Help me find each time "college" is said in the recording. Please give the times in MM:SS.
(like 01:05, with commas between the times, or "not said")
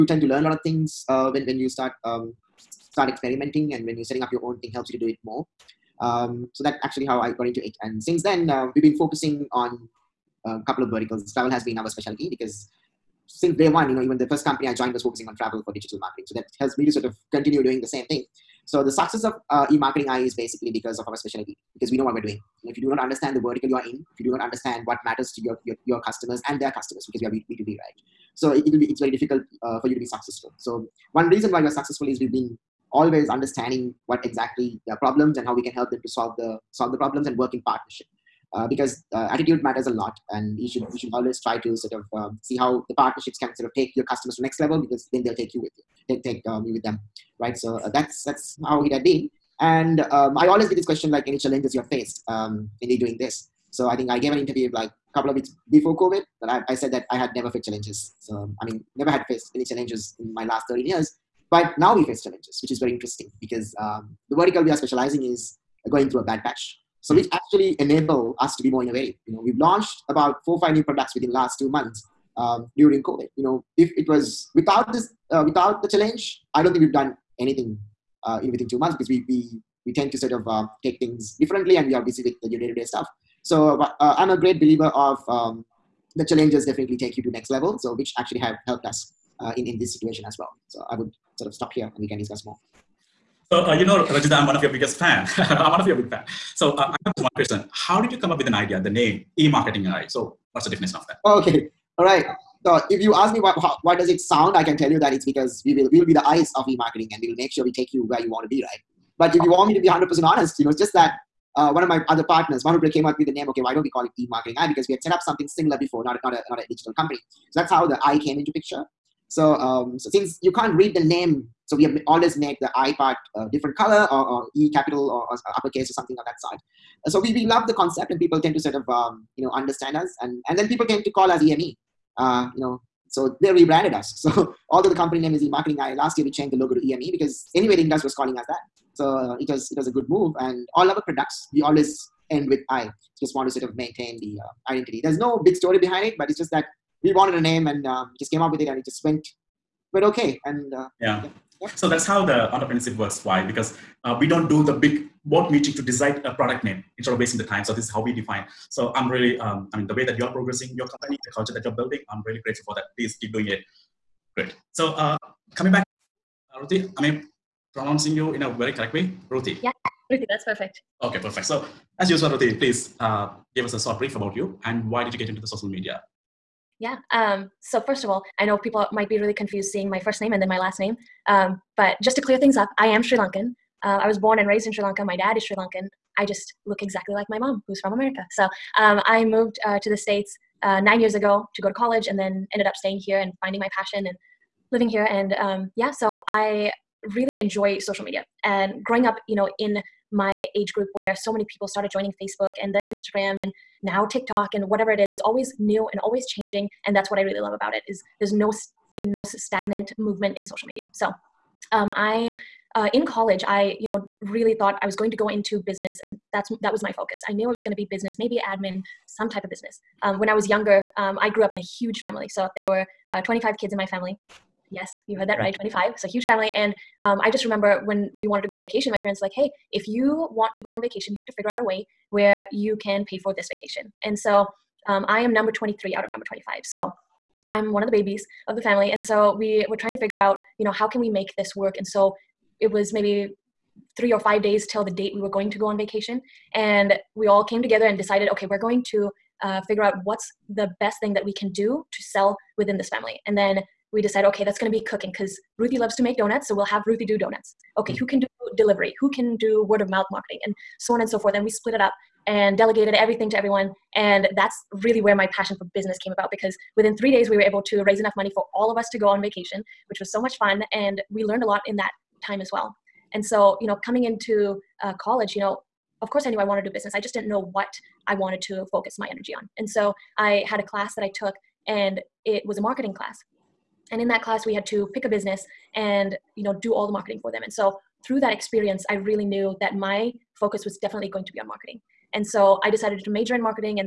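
03:11, 03:33, 04:35.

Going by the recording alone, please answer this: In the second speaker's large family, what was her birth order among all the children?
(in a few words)
23.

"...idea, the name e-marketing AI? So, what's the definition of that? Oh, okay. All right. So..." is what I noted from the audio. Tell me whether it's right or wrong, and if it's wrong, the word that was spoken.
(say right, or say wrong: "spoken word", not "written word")
right.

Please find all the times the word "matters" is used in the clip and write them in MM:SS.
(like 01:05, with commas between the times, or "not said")
00:25, 00:39.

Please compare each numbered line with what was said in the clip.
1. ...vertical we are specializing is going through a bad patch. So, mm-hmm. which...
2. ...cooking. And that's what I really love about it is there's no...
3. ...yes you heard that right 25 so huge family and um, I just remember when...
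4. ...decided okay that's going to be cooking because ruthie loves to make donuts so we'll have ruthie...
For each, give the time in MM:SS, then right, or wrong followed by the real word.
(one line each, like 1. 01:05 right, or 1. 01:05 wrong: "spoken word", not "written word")
1. 01:04 right
2. 03:26 wrong: "changing", not "cooking"
3. 03:44 right
4. 04:14 right.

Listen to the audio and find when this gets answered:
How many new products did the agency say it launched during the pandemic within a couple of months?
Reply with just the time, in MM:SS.
01:10.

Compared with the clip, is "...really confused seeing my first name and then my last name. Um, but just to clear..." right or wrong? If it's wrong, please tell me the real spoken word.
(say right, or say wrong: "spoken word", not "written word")
right.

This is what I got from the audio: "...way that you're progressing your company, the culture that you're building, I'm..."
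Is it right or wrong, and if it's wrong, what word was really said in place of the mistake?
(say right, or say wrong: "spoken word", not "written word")
right.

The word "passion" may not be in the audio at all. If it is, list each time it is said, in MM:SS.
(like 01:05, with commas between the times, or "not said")
03:13, 04:25.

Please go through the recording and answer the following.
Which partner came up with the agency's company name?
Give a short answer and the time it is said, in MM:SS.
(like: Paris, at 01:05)
Manupre, at 01:52.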